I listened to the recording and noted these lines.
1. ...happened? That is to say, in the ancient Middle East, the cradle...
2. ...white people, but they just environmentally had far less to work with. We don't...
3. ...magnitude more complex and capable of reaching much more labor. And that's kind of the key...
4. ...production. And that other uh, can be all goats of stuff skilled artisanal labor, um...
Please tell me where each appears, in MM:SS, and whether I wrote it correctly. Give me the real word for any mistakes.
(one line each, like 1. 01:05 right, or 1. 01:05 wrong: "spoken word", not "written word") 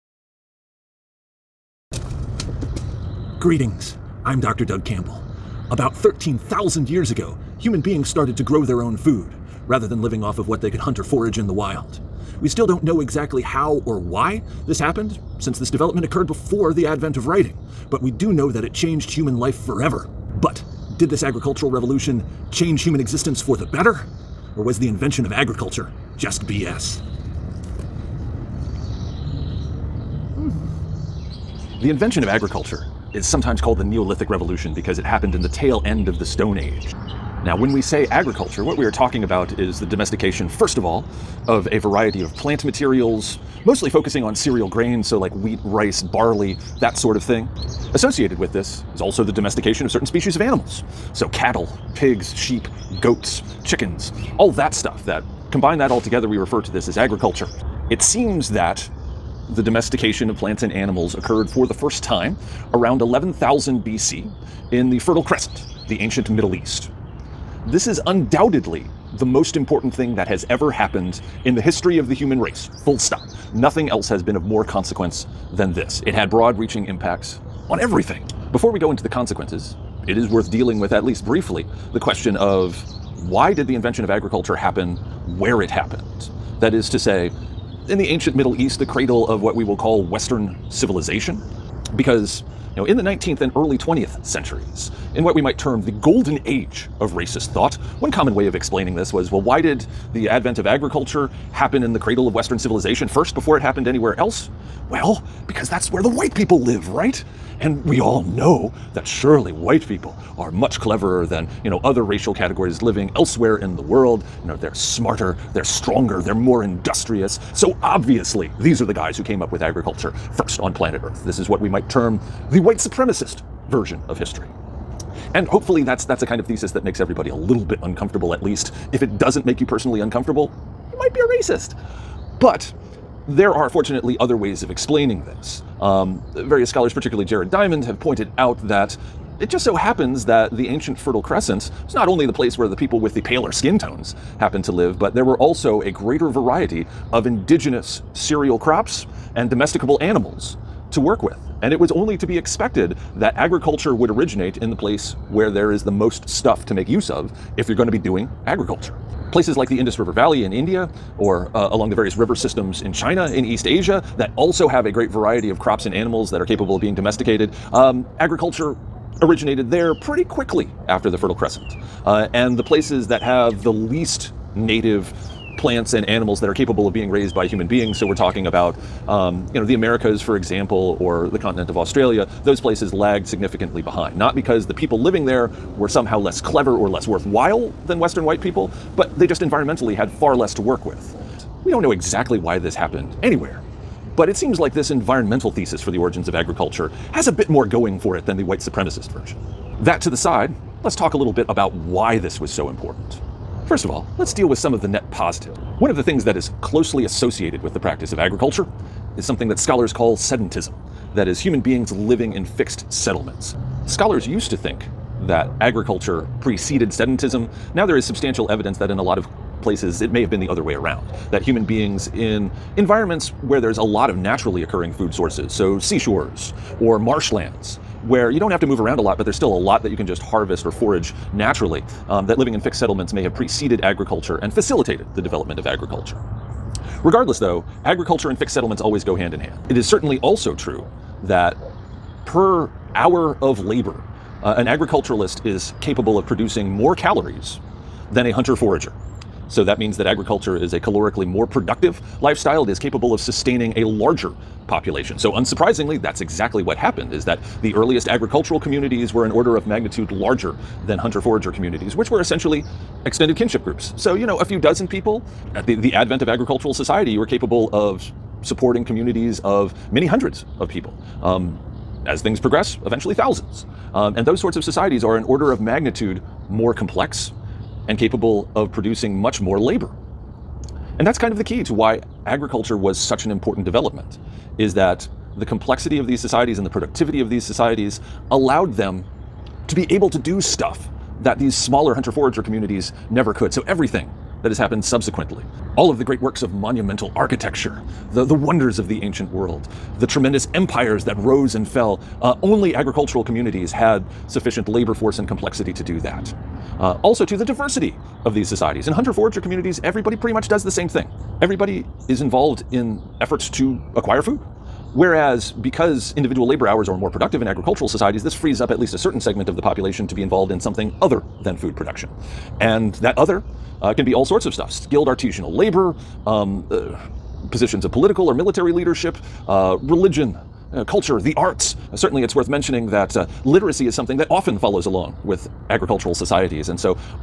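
1. 01:25 right
2. 03:08 right
3. 04:35 wrong: "producing", not "reaching"
4. 05:21 wrong: "sorts", not "goats".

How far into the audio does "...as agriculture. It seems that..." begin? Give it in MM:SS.
00:56.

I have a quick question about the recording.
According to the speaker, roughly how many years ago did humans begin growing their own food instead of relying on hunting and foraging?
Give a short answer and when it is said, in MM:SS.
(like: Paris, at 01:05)
13,000, at 00:05.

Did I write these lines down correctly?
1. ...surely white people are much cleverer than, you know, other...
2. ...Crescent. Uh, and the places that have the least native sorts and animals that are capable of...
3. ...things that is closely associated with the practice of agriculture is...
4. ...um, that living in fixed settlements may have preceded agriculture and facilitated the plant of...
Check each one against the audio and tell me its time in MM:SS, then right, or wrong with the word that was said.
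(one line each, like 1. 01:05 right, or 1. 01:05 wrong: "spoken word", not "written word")
1. 01:49 right
2. 02:51 wrong: "plants", not "sorts"
3. 03:26 right
4. 03:52 wrong: "development", not "plant".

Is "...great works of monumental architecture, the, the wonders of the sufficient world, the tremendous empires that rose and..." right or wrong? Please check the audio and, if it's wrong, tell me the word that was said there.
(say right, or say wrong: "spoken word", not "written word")
wrong: "ancient", not "sufficient".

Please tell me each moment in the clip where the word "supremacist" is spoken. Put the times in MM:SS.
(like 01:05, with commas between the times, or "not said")
02:02, 03:18.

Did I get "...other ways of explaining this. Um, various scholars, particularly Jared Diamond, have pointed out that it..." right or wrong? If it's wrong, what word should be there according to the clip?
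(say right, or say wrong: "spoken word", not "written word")
right.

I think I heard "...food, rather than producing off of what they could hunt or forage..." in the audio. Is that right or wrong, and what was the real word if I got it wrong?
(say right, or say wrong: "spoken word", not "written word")
wrong: "living", not "producing".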